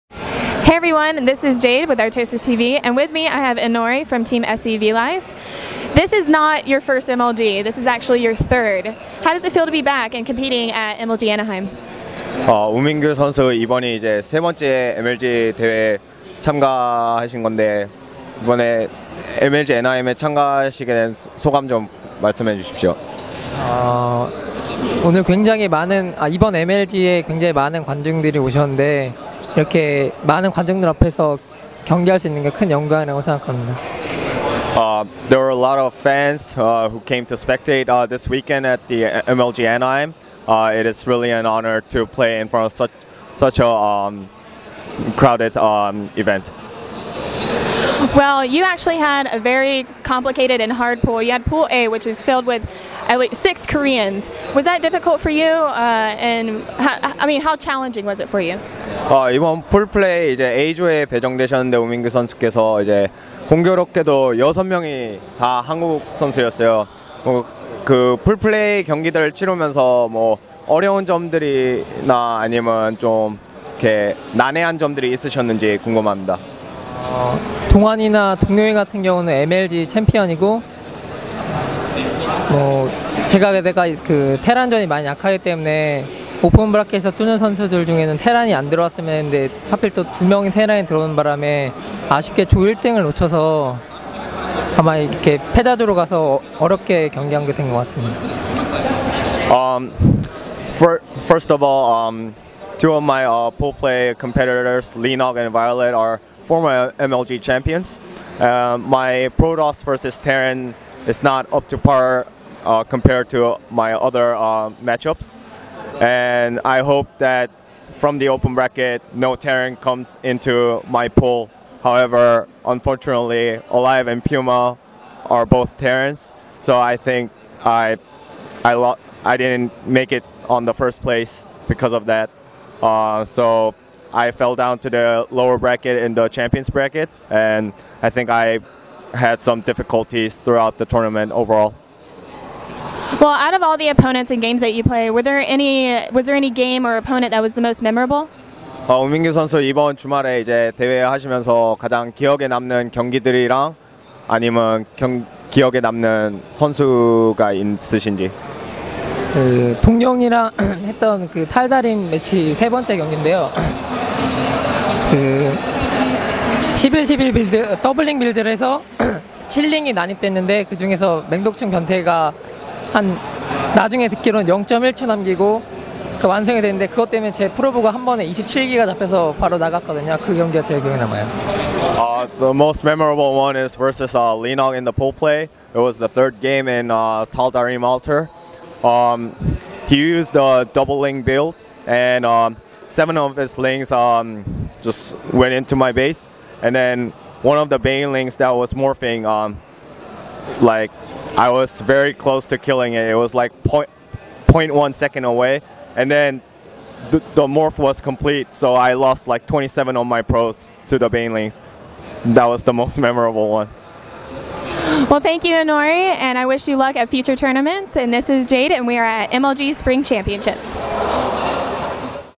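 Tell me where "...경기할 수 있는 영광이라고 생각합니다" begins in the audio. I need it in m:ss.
0:31.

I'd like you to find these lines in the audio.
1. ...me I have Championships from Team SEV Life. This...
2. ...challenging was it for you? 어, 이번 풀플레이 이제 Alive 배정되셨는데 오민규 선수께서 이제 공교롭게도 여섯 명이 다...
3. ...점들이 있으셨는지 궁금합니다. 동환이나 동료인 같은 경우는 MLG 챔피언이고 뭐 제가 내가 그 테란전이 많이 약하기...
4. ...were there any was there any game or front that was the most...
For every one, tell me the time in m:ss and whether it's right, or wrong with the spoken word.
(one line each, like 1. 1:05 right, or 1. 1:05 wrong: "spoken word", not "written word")
1. 0:03 wrong: "Inori", not "Championships"
2. 0:57 wrong: "A조에", not "Alive"
3. 1:14 right
4. 2:25 wrong: "opponent", not "front".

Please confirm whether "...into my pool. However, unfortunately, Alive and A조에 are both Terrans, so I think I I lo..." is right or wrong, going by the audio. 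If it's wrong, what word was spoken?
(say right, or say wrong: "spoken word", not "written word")
wrong: "Puma", not "A조에".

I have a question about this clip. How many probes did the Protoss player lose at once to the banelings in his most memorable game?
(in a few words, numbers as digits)
27.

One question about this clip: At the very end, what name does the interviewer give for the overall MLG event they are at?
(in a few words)
MLG Spring Championships.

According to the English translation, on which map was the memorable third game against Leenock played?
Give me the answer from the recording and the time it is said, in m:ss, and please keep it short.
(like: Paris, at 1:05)
Tal Darim, at 3:07.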